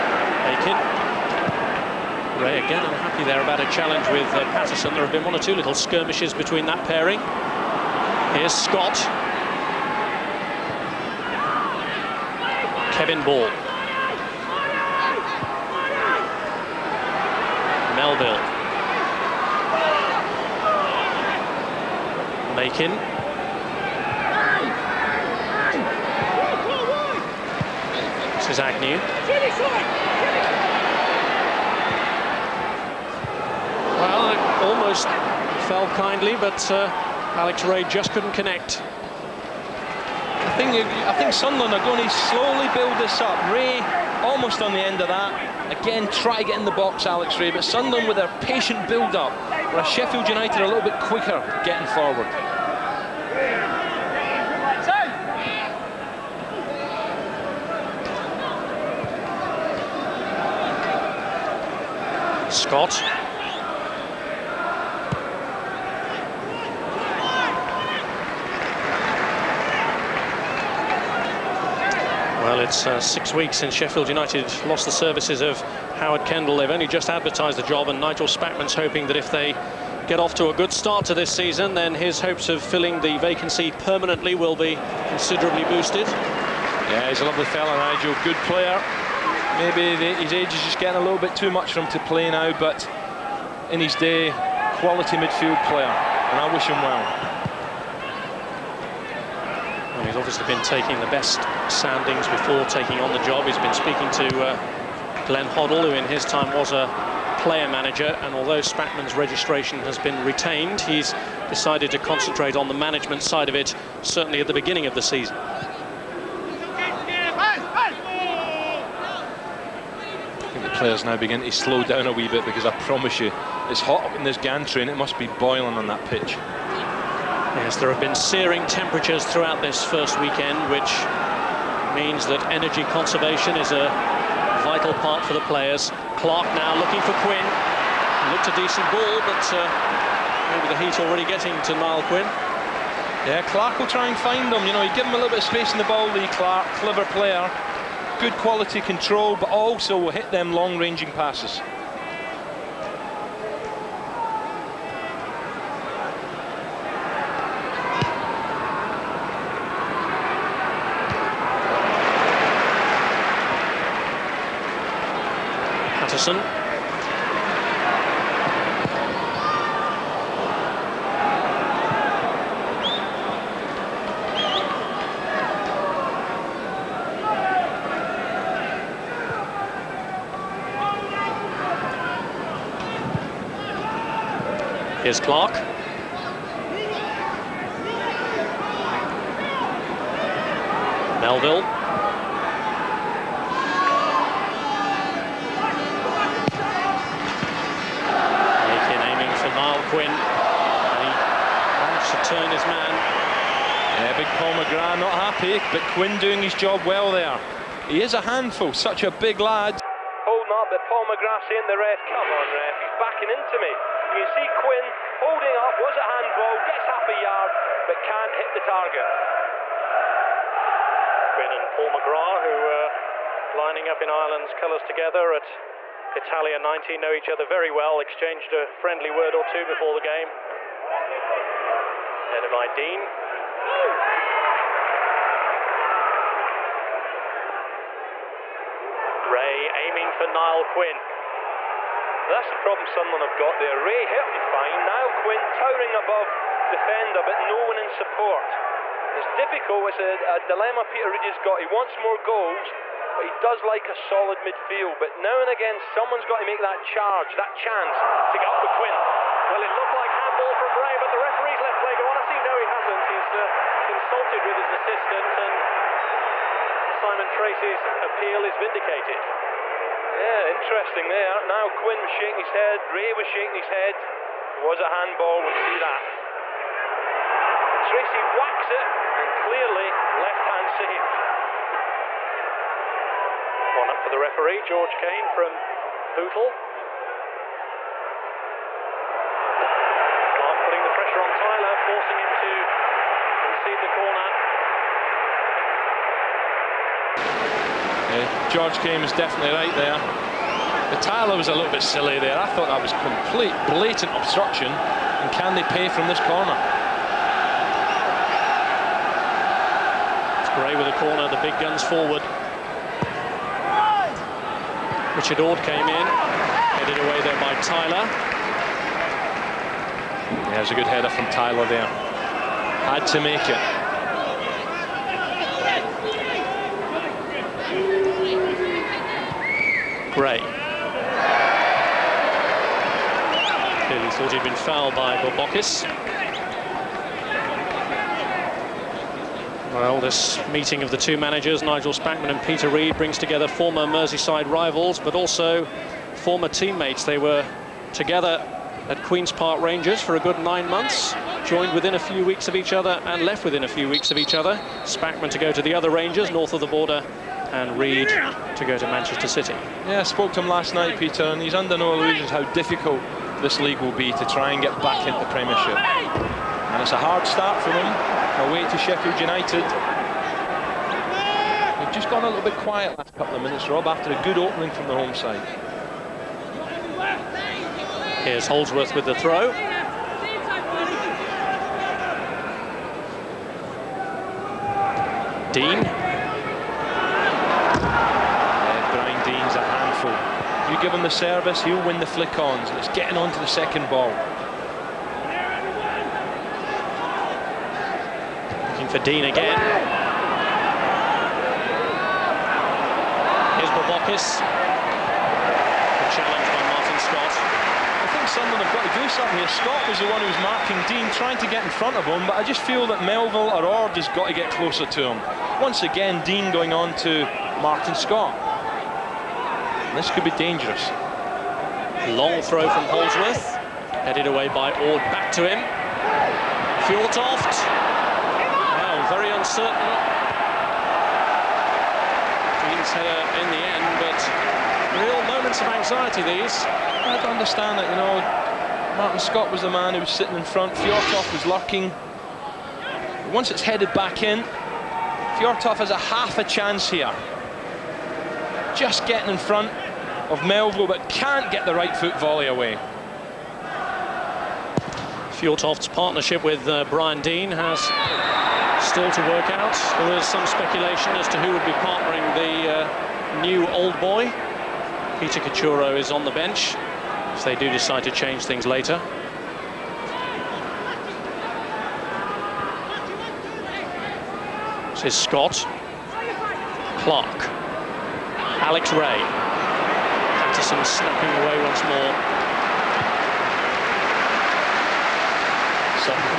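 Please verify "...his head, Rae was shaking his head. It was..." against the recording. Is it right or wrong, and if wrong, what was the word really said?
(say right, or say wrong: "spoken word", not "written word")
right.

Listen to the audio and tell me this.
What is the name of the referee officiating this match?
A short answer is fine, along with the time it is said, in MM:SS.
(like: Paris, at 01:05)
George Cain, at 04:44.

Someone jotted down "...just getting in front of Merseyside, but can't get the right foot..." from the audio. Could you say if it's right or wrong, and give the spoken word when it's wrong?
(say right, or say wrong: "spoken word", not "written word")
wrong: "Melville", not "Merseyside".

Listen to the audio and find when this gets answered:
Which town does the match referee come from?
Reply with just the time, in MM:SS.
04:46.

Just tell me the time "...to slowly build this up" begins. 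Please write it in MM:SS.
00:42.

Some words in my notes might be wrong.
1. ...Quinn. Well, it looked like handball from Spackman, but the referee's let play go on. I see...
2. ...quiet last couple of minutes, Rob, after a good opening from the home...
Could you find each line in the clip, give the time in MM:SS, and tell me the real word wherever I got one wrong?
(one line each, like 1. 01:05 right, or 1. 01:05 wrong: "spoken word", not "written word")
1. 04:18 wrong: "Rae", not "Spackman"
2. 06:12 right.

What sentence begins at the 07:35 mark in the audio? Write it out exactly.
Fjortoft's partnership with uh, Brian Deane has still to work out.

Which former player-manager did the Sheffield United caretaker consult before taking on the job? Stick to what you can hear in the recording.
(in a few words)
Glenn Hoddle.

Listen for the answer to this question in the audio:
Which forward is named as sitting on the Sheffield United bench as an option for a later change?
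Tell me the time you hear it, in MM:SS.
07:45.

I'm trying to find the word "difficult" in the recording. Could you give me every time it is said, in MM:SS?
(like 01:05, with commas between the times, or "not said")
04:09, 06:02.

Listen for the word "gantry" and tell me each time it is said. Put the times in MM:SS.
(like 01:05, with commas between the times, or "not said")
02:04.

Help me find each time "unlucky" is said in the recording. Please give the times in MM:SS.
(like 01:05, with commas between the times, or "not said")
00:03.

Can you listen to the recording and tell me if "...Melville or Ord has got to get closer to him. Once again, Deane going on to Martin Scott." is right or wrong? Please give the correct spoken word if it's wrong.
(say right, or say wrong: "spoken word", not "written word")
right.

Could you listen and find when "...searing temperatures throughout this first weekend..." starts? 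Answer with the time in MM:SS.
02:08.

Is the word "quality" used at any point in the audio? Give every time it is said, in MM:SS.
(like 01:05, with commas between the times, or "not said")
01:34, 02:28.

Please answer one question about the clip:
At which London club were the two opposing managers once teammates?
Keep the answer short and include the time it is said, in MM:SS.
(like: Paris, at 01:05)
Queen's Park Rangers, at 05:49.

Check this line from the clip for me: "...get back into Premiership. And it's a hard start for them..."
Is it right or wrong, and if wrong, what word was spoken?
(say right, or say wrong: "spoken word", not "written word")
right.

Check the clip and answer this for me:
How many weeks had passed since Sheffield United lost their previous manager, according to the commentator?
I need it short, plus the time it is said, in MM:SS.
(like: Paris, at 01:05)
6, at 01:13.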